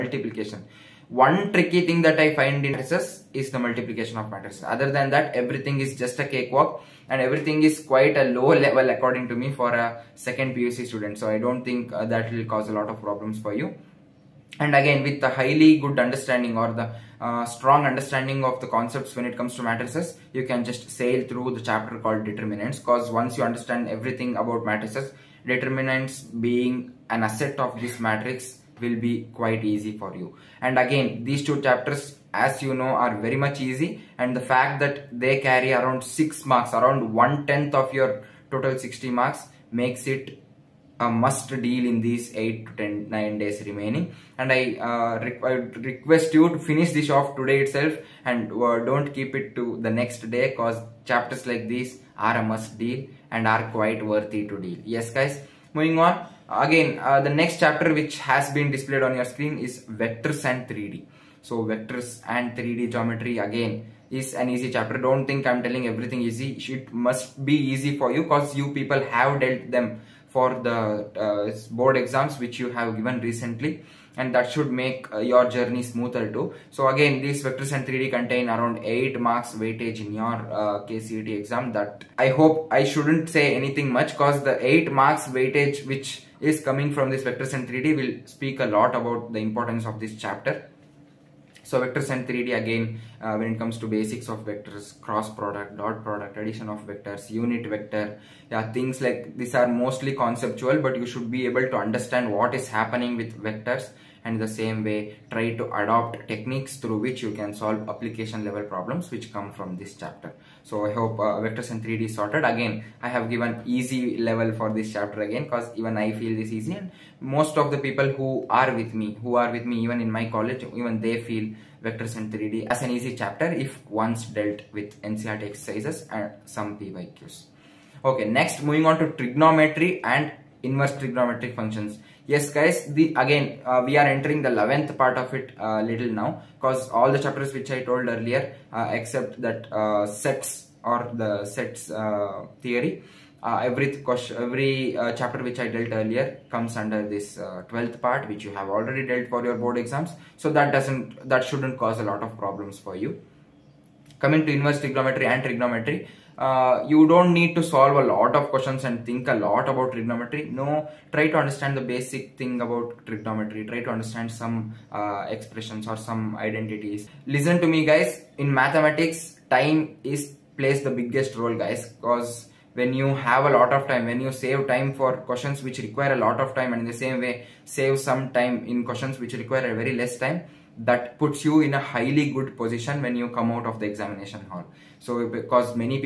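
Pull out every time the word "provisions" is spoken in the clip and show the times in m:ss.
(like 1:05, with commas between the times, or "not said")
not said.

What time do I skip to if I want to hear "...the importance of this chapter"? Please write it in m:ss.
1:29.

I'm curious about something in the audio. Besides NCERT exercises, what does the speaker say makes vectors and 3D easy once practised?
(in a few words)
PYQs.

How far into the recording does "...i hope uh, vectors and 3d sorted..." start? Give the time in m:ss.
1:50.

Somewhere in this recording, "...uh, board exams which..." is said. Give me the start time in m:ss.
1:11.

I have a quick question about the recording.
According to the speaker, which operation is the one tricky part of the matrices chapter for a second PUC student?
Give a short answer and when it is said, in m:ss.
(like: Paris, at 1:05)
Multiplication of matrices, at 0:03.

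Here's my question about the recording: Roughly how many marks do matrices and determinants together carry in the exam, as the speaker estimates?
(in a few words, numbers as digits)
6.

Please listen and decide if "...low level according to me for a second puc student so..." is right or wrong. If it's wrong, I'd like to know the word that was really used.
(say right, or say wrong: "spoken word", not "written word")
right.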